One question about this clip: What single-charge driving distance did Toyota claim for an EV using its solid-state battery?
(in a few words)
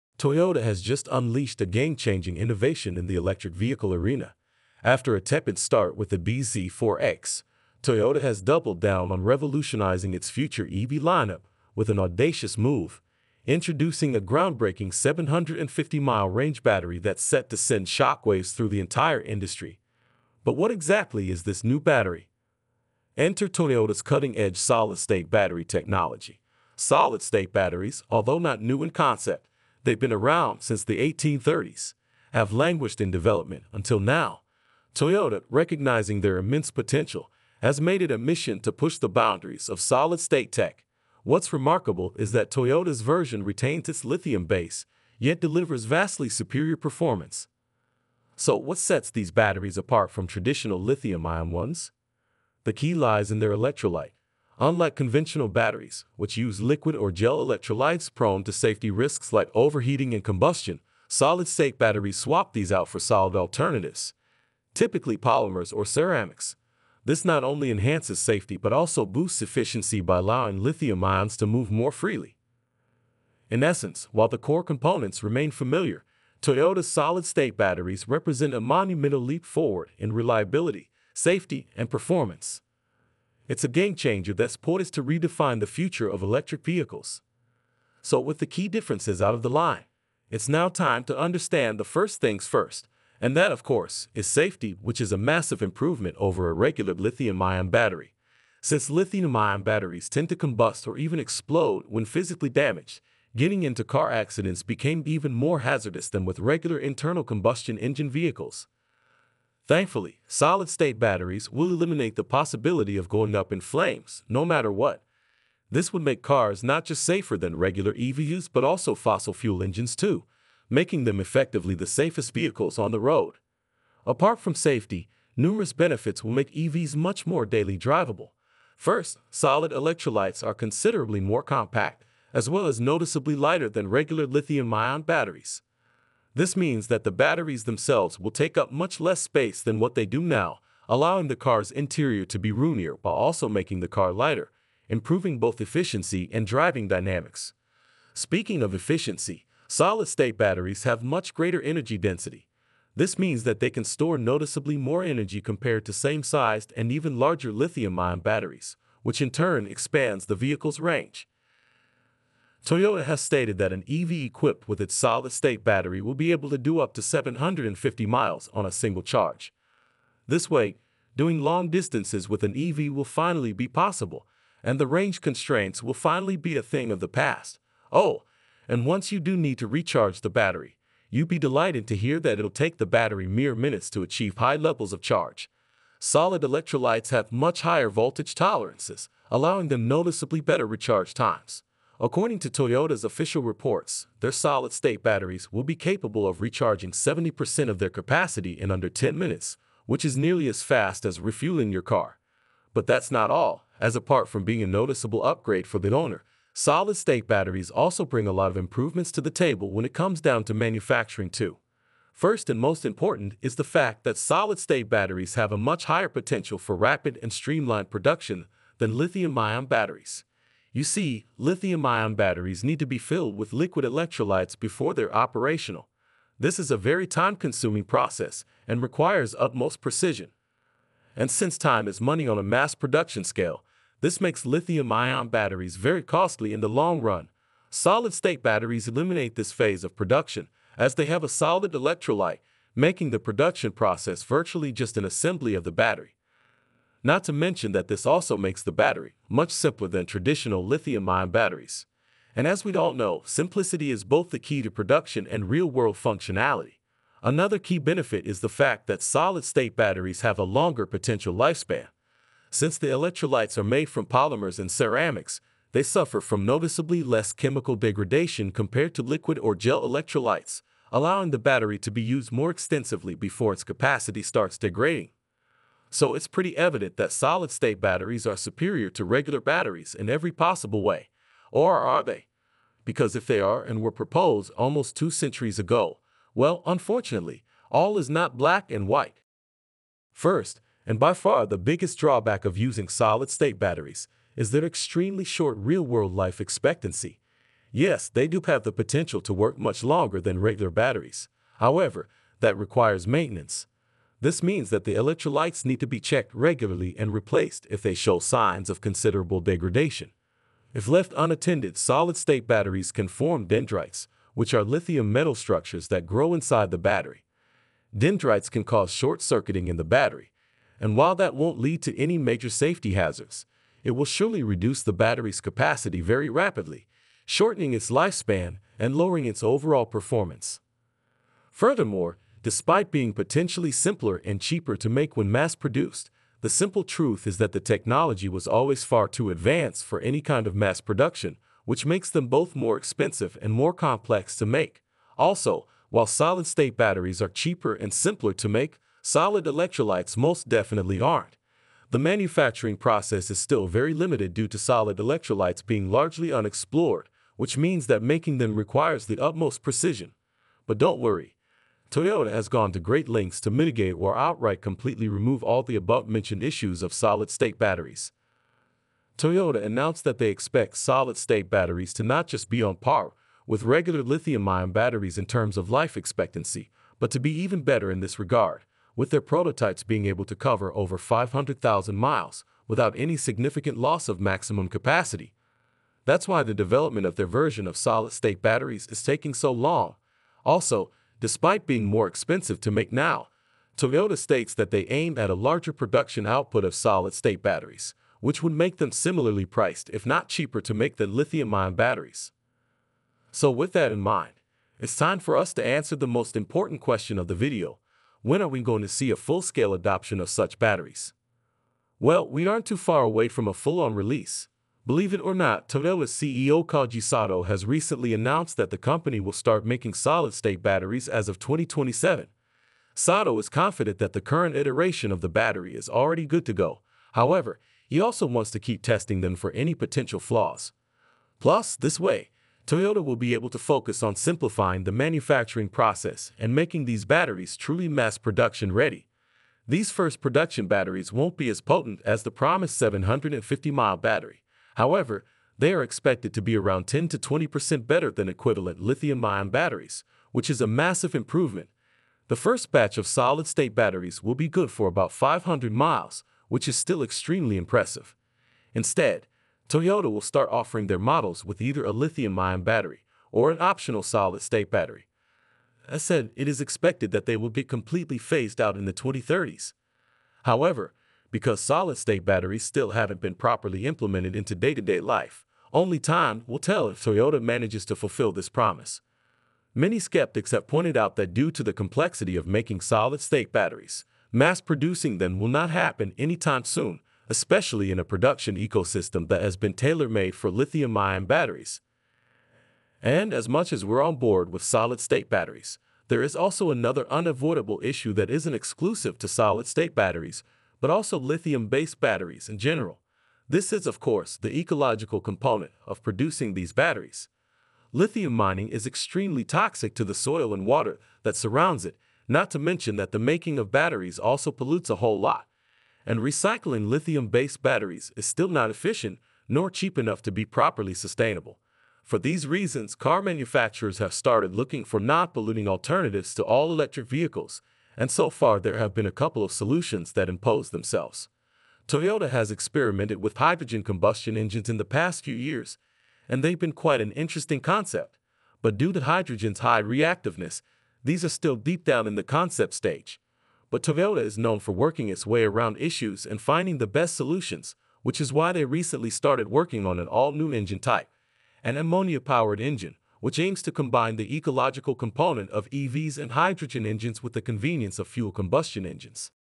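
750 miles.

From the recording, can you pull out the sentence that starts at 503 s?
This is, of course, the ecological component of producing these batteries.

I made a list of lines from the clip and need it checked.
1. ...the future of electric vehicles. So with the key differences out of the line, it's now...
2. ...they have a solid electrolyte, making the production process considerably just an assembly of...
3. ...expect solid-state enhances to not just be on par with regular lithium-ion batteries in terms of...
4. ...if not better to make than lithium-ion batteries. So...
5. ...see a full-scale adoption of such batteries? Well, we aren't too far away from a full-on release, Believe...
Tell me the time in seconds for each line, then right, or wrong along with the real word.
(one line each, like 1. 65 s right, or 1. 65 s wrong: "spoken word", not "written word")
1. 85 s right
2. 240 s wrong: "virtually", not "considerably"
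3. 370 s wrong: "batteries", not "enhances"
4. 399 s wrong: "cheaper", not "better"
5. 408 s right.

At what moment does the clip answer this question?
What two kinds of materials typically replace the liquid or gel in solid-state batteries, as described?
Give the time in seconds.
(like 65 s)
65 s.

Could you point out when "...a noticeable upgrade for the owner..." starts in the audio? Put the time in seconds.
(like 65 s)
204 s.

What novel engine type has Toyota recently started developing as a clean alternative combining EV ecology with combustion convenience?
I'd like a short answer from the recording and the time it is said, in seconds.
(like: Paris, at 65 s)
ammonia-powered engine, at 551 s.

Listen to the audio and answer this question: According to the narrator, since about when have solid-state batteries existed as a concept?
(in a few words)
1830s.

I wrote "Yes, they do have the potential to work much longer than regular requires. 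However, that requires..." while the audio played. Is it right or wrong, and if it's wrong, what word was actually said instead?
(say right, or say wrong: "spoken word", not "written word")
wrong: "batteries", not "requires".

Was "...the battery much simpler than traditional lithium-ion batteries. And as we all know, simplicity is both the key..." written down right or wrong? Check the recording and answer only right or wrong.
right.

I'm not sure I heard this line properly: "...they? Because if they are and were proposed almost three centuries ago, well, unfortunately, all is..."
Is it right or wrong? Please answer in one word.
wrong.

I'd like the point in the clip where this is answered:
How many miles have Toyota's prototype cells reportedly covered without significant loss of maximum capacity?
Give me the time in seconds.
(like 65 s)
380 s.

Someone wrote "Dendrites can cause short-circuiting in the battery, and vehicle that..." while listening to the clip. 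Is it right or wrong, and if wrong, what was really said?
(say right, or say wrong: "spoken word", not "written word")
wrong: "while", not "vehicle".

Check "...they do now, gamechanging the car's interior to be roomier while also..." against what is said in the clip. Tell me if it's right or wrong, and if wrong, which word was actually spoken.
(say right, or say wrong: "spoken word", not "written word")
wrong: "allowing", not "gamechanging".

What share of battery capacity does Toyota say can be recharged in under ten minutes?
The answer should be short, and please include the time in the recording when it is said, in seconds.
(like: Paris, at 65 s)
70%, at 196 s.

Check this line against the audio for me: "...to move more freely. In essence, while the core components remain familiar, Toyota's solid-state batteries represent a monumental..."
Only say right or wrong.
right.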